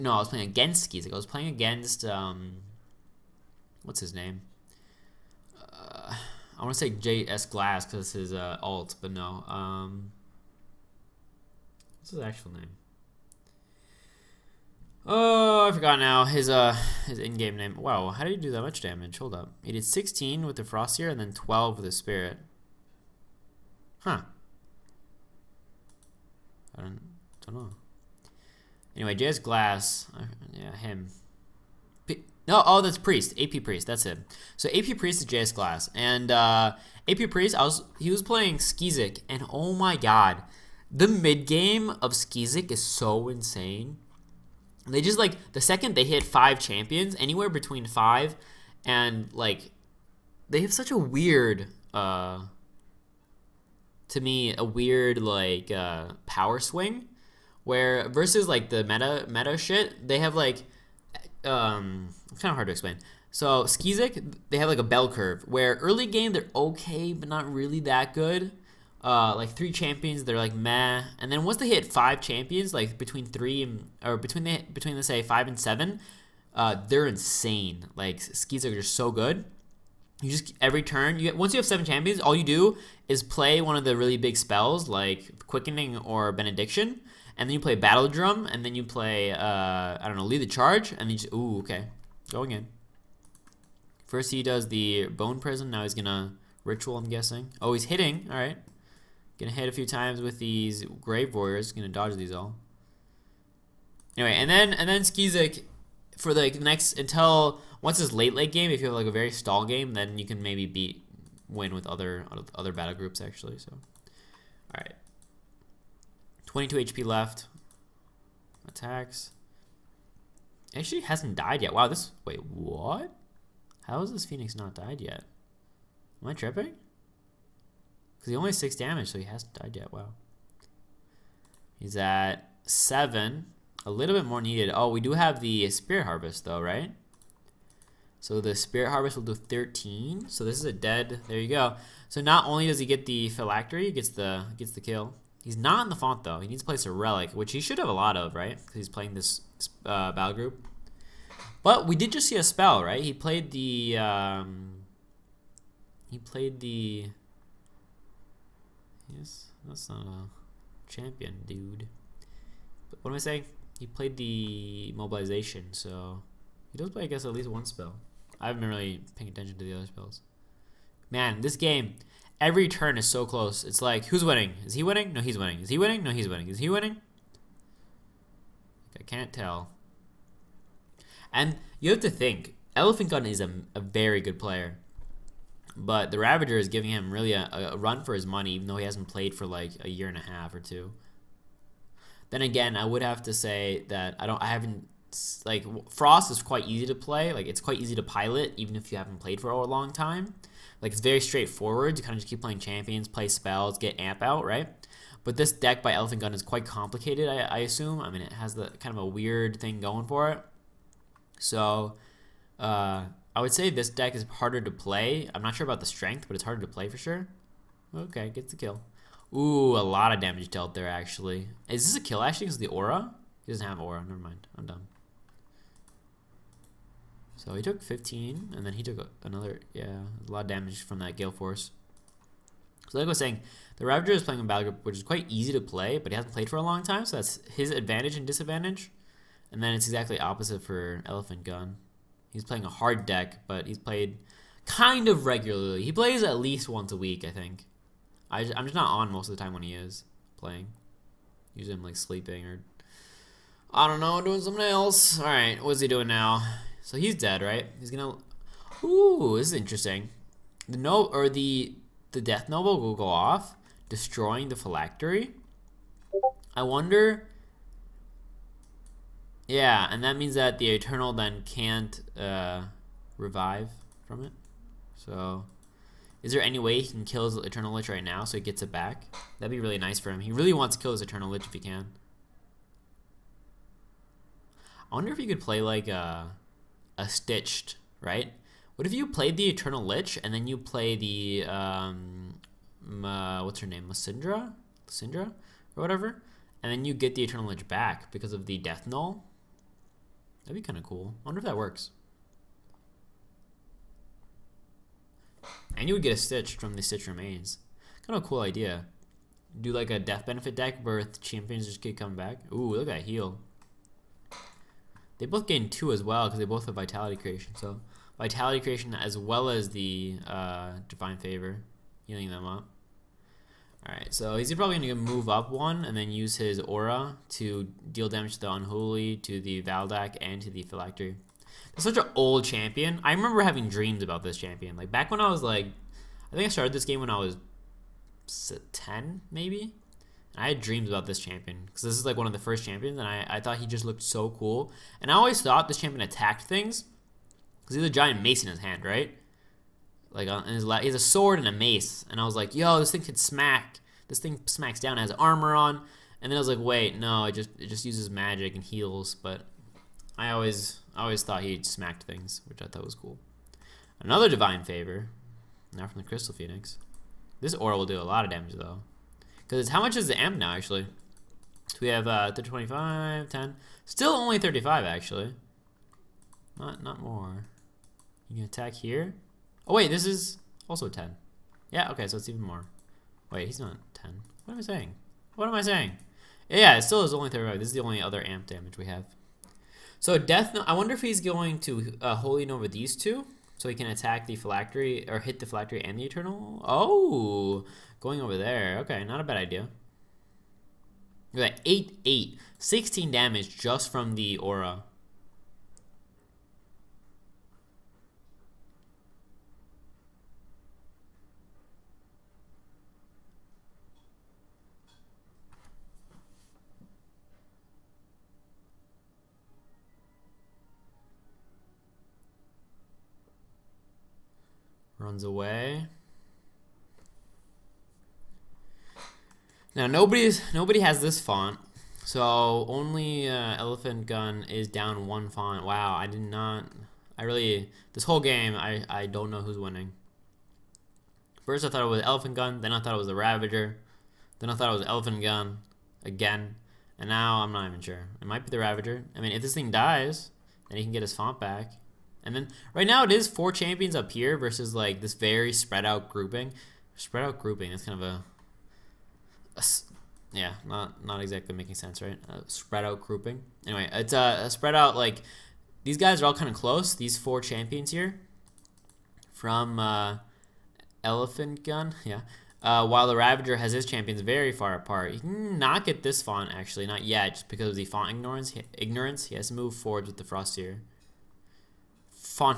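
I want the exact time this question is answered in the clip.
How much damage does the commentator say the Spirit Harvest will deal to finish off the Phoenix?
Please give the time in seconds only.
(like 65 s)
139 s.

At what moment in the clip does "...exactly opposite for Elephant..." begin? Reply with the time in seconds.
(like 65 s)
239 s.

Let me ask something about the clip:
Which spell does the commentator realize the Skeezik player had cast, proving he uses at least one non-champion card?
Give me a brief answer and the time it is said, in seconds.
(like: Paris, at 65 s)
mobilization, at 164 s.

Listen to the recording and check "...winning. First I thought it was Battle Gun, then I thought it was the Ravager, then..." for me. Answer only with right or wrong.
wrong.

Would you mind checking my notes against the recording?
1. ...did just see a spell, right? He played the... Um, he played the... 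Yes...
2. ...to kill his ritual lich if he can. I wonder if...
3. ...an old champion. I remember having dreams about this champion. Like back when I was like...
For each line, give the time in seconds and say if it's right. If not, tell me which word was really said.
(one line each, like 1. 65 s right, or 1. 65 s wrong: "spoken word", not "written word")
1. 151 s right
2. 280 s wrong: "eternal", not "ritual"
3. 331 s right.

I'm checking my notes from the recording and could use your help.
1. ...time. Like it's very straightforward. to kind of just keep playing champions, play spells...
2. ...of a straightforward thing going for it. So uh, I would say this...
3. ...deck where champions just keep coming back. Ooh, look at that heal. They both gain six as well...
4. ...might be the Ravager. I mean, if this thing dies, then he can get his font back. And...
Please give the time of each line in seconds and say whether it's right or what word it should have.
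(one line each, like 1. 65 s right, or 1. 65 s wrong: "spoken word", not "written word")
1. 199 s right
2. 208 s wrong: "weird", not "straightforward"
3. 310 s wrong: "two", not "six"
4. 448 s right.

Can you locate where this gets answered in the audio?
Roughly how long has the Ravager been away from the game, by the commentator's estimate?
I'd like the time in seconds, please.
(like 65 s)
189 s.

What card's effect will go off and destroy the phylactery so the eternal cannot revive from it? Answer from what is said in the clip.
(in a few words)
Death Nova.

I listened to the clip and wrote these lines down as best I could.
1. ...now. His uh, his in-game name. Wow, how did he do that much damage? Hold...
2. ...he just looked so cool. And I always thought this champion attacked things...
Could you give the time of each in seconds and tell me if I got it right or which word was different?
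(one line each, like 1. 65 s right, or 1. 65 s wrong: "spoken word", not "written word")
1. 15 s right
2. 343 s right.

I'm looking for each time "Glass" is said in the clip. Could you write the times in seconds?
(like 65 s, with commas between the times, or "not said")
7 s, 29 s, 35 s.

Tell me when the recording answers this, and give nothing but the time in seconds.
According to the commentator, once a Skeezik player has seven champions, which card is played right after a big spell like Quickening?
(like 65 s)
87 s.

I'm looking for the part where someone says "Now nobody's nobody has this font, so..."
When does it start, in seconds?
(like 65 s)
429 s.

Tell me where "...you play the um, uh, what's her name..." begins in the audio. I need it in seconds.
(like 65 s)
290 s.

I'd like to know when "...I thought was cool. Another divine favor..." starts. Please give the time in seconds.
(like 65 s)
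362 s.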